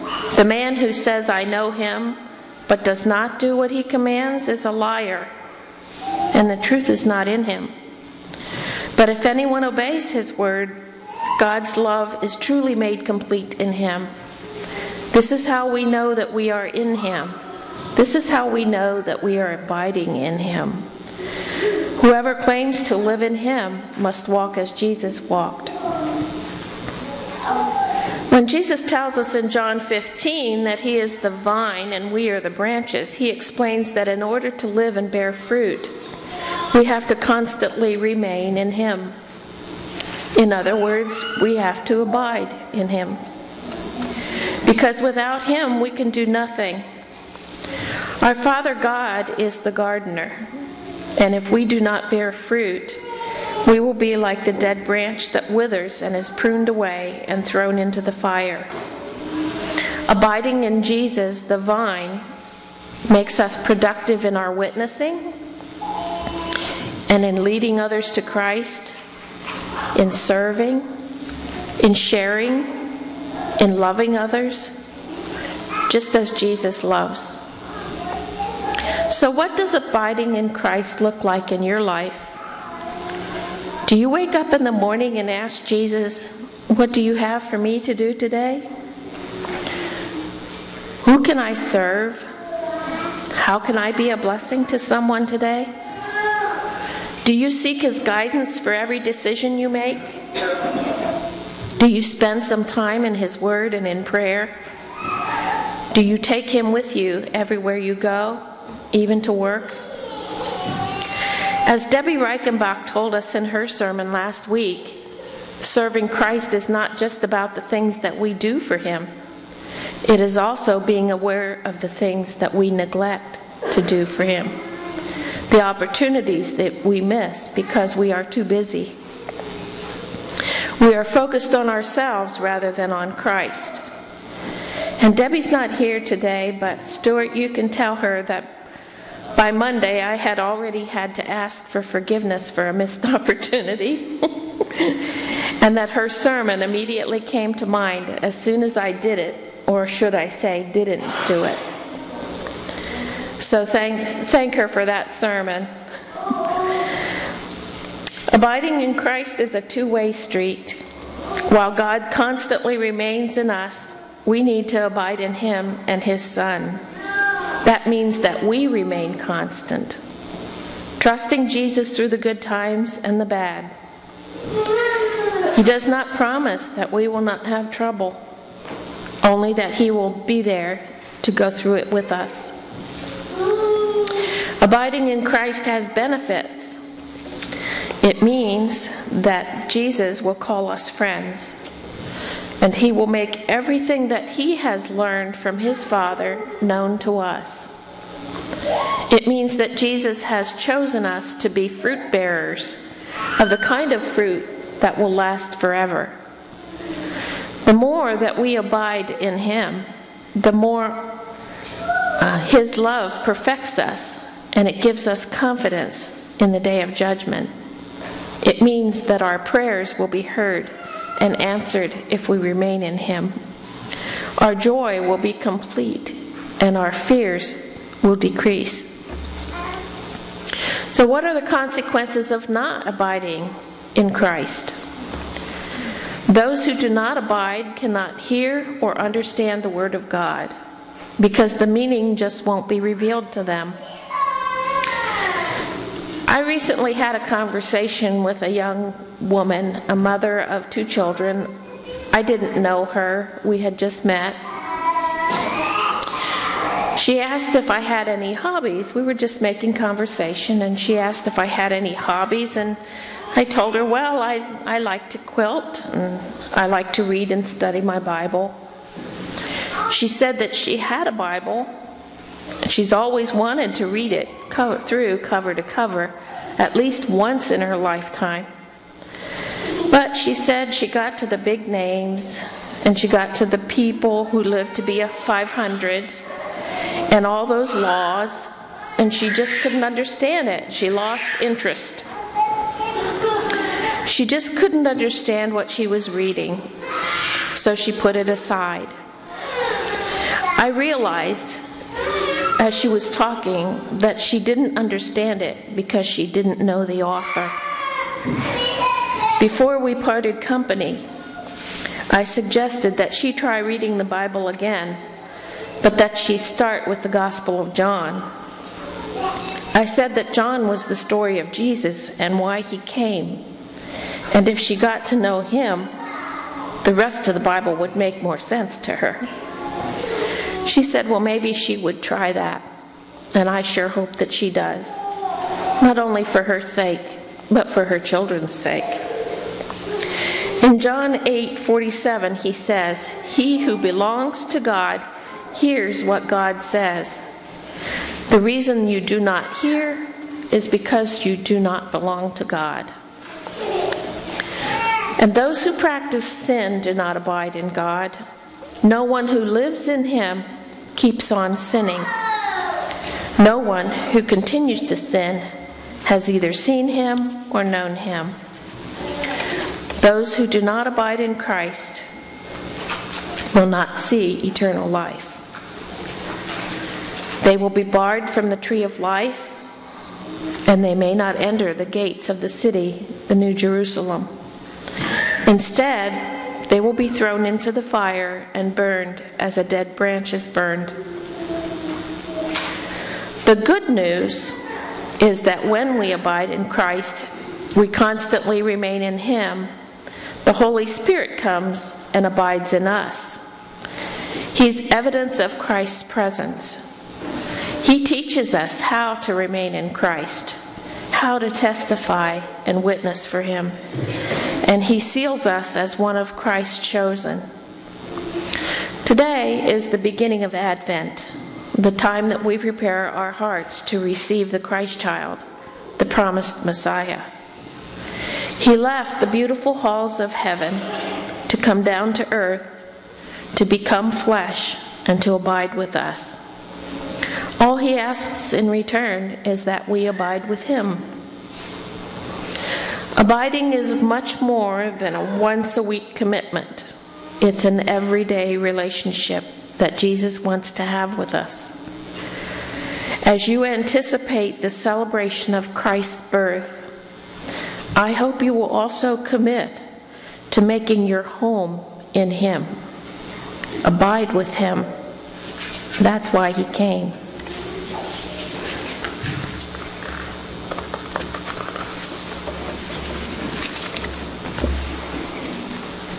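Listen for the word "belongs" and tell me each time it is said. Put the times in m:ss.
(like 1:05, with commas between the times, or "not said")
5:43, 5:51.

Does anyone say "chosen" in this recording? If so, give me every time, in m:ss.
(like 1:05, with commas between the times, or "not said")
3:20, 6:56.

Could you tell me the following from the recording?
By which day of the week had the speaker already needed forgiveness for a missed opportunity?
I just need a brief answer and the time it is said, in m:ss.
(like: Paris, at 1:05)
Monday, at 2:19.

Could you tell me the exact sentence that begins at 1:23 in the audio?
Do you wake up in the morning and ask Jesus, What do you have for me to do today?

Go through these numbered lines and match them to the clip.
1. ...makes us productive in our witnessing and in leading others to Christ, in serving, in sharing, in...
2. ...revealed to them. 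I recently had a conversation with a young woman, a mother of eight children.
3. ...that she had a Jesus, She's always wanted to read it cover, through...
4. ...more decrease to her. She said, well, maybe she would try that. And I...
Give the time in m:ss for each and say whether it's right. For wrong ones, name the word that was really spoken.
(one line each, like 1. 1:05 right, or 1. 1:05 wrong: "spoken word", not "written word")
1. 1:03 right
2. 4:02 wrong: "two", not "eight"
3. 4:30 wrong: "Bible", not "Jesus"
4. 5:28 wrong: "sense", not "decrease".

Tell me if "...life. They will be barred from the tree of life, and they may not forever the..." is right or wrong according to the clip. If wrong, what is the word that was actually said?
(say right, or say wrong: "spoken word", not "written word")
wrong: "enter", not "forever".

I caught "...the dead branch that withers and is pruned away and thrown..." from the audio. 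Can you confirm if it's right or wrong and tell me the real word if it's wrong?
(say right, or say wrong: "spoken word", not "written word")
right.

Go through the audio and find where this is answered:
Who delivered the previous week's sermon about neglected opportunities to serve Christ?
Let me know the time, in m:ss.
1:51.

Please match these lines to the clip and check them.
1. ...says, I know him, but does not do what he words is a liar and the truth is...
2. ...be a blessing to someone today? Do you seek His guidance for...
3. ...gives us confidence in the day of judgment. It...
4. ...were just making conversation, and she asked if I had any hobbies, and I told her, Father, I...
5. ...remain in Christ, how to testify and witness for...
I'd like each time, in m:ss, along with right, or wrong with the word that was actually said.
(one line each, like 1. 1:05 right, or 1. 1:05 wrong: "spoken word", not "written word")
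1. 0:00 wrong: "commands", not "words"
2. 1:33 right
3. 3:34 right
4. 4:19 wrong: "Well", not "Father"
5. 6:49 right.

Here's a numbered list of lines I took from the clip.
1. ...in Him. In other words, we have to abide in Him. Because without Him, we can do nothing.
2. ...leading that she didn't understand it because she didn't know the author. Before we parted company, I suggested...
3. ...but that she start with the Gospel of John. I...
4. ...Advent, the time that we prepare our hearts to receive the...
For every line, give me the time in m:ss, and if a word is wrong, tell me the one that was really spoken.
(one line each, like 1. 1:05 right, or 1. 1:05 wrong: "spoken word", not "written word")
1. 0:38 right
2. 5:03 wrong: "talking", not "leading"
3. 5:15 right
4. 7:00 right.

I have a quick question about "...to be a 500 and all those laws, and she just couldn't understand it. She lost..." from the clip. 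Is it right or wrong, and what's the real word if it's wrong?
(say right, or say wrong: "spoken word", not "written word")
right.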